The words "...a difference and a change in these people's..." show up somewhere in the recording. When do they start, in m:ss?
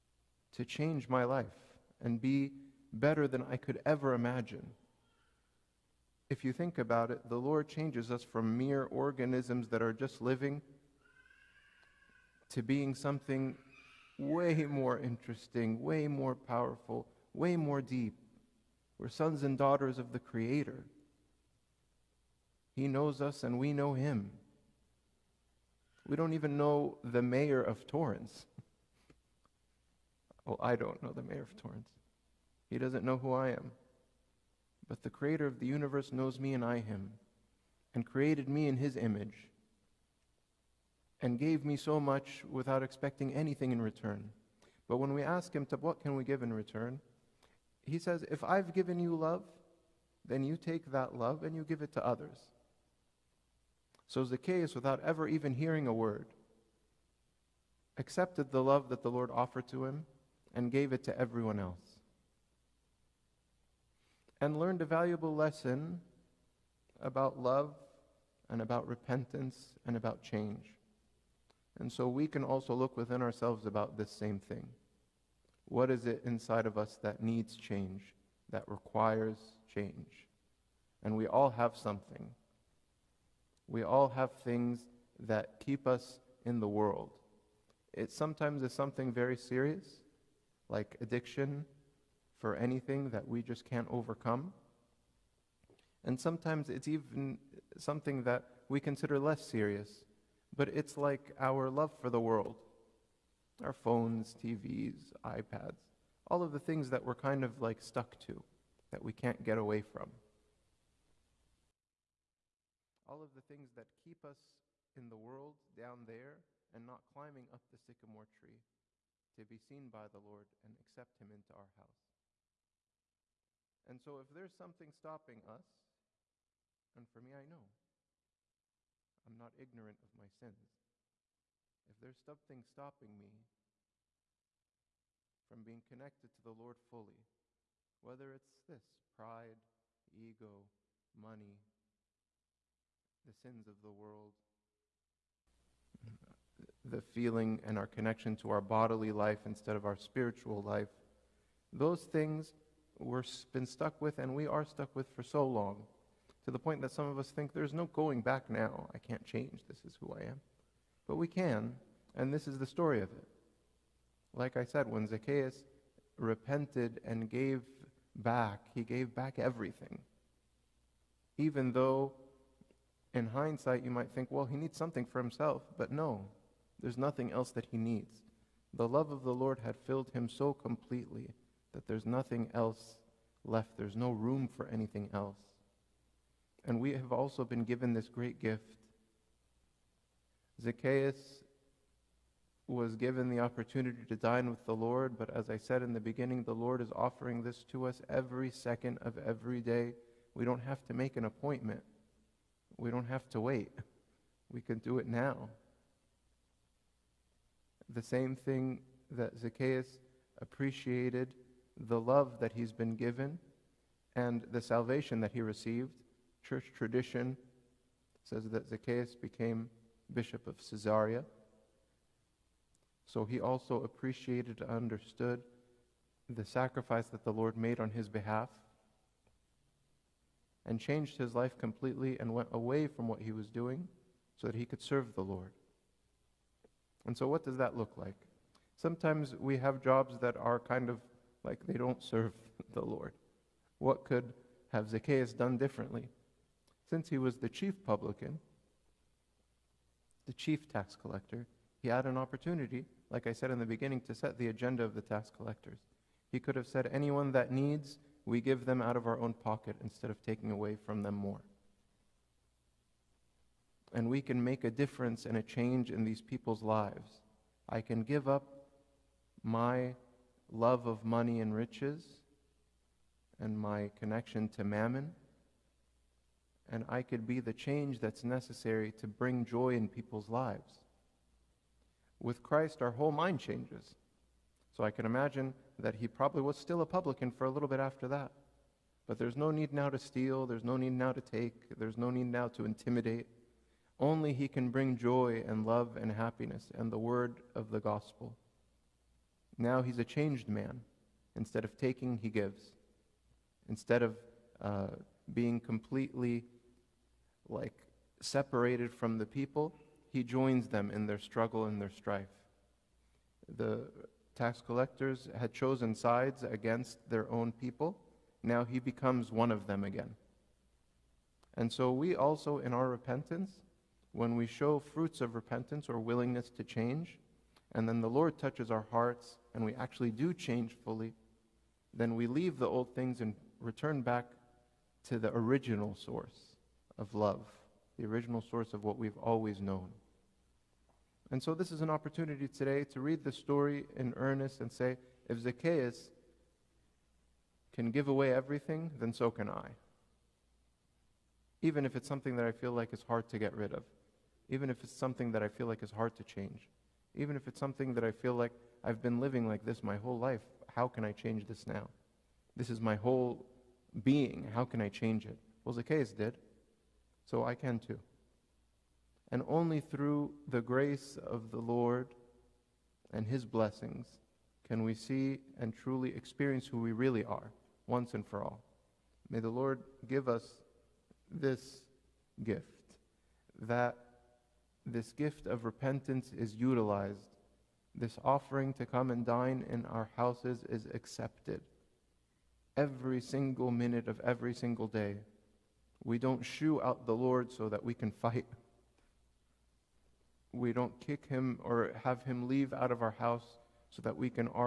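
4:24.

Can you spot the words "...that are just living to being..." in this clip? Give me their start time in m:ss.
0:09.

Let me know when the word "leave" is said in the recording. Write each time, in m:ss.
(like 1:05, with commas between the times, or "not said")
5:32, 6:42.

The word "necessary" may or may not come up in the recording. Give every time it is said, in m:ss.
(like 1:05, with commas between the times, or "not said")
4:38.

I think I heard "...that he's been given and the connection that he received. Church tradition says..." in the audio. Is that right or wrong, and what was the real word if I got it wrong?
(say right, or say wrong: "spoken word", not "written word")
wrong: "salvation", not "connection".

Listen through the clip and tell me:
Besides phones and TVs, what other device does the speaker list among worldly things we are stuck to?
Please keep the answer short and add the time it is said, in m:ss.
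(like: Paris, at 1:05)
iPads, at 1:45.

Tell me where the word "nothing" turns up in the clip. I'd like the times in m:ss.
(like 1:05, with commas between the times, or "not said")
2:56, 3:02.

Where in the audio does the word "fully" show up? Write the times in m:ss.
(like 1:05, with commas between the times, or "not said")
2:16, 5:30.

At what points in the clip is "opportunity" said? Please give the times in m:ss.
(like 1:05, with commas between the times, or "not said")
3:13, 4:12, 5:41.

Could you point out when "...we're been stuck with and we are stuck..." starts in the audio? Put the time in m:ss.
2:32.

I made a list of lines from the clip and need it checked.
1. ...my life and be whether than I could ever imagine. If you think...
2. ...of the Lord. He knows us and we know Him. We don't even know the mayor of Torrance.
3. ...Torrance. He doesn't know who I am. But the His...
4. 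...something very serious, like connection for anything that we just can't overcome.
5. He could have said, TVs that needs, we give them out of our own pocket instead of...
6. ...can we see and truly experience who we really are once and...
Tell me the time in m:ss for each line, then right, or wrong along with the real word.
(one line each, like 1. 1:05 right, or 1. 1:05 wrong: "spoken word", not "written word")
1. 0:01 wrong: "better", not "whether"
2. 0:19 wrong: "Creator", not "Lord"
3. 0:31 wrong: "Creator", not "His"
4. 1:28 wrong: "addiction", not "connection"
5. 4:16 wrong: "Anyone", not "TVs"
6. 6:14 right.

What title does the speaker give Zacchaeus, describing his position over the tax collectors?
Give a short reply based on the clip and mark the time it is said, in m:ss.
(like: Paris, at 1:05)
chief publican, at 4:07.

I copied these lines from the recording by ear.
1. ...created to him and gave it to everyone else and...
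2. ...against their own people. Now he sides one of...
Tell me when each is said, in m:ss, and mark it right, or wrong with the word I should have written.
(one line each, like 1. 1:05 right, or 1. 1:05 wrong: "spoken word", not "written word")
1. 0:59 wrong: "offered", not "created"
2. 5:16 wrong: "becomes", not "sides".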